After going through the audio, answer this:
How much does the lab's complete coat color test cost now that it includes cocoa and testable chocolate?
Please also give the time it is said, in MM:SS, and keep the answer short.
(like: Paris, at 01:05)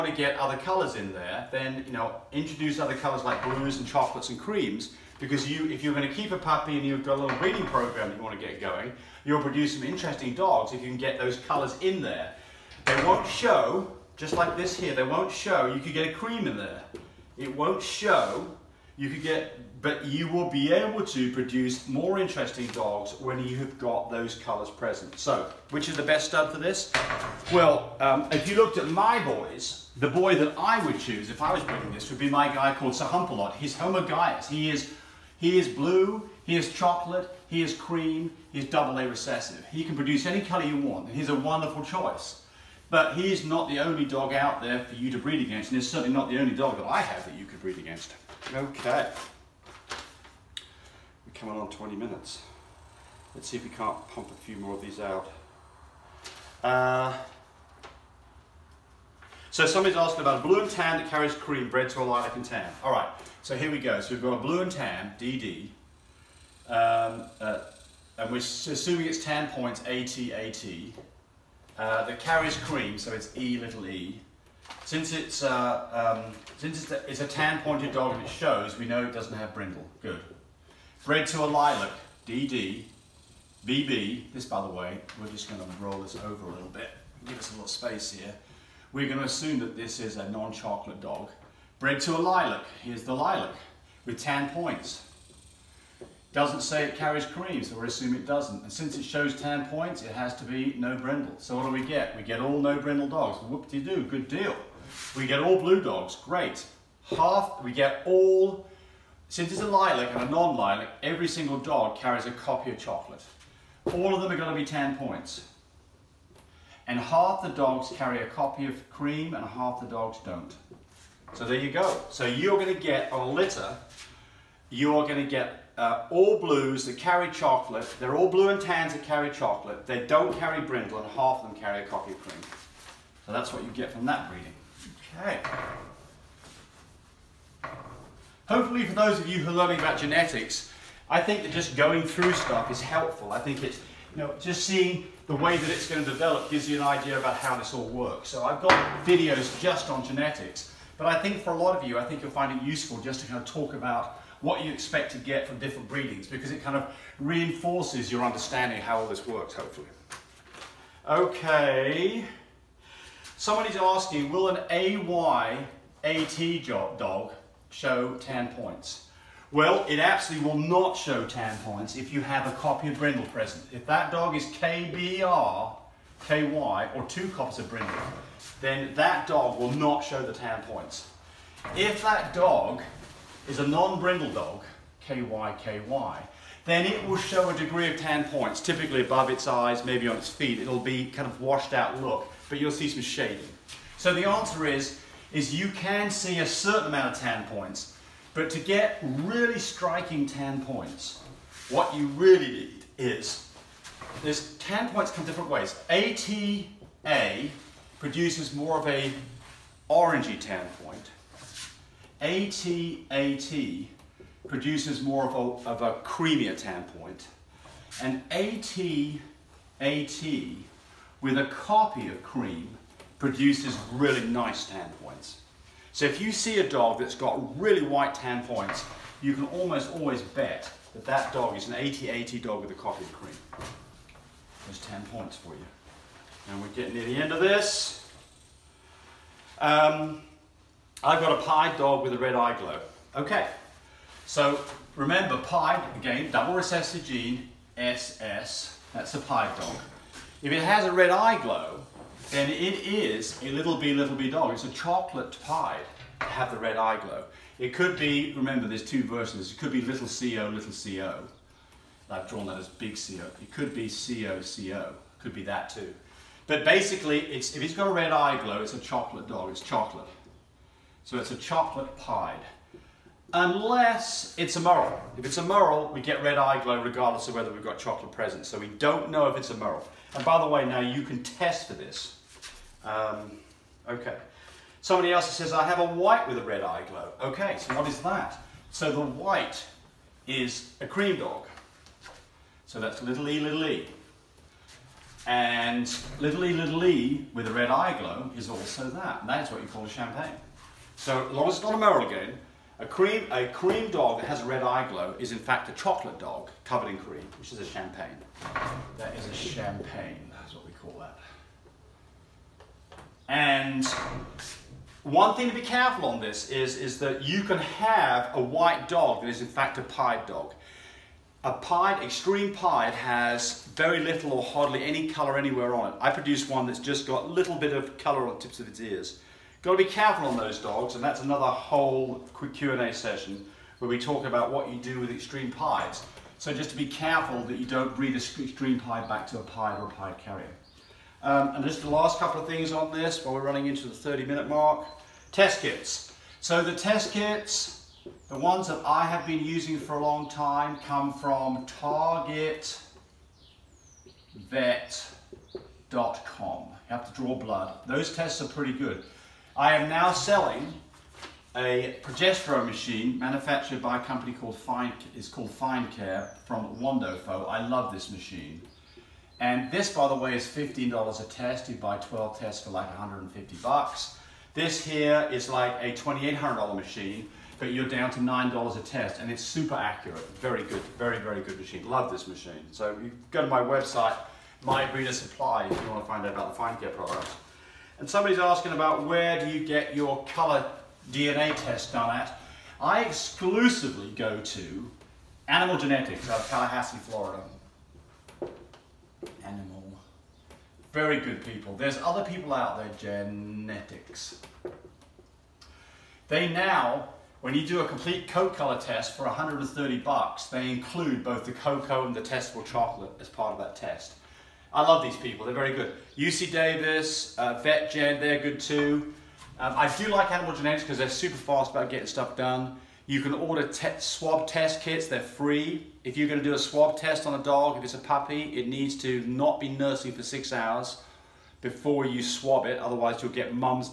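$130, at 06:49.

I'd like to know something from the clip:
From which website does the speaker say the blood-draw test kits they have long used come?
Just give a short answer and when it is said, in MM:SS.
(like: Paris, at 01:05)
targetvet.com, at 05:51.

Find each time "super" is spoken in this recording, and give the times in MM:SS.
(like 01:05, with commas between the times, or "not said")
06:19, 07:01.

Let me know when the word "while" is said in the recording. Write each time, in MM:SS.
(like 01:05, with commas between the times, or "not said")
05:43.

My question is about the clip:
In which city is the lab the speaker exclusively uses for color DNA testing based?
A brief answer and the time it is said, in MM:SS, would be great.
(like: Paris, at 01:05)
Tallahassee, at 06:36.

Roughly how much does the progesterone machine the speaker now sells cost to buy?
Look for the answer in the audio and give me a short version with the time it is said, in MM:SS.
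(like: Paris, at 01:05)
$2,800, at 06:15.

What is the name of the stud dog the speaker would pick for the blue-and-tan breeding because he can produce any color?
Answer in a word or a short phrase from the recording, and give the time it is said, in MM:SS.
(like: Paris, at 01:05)
Sir Humpalot, at 00:32.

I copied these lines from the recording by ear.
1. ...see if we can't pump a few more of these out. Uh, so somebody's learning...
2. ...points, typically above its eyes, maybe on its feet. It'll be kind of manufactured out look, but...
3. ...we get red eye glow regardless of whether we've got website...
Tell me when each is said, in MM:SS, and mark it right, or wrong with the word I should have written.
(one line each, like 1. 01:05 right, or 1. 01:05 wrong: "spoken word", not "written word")
1. 00:53 wrong: "asking", not "learning"
2. 03:08 wrong: "washed", not "manufactured"
3. 04:35 wrong: "chocolate", not "website".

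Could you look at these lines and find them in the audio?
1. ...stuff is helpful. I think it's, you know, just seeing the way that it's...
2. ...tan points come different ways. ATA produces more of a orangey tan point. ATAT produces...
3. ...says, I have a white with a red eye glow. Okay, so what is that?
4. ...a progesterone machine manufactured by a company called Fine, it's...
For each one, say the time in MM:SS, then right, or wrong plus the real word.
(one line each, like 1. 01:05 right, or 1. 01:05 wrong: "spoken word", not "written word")
1. 02:22 right
2. 03:24 right
3. 04:45 right
4. 06:01 right.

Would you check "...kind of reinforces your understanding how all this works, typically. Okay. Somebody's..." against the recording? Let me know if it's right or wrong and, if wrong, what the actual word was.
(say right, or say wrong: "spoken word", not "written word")
wrong: "hopefully", not "typically".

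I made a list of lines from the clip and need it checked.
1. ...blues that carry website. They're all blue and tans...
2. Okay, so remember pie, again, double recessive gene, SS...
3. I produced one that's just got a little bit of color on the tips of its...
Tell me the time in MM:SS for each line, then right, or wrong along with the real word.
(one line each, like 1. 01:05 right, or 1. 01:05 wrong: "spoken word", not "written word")
1. 02:06 wrong: "chocolate", not "website"
2. 04:03 right
3. 05:26 right.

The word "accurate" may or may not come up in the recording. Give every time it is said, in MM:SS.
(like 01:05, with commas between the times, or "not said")
06:19.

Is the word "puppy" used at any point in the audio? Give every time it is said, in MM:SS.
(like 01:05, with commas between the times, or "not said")
00:06, 07:07.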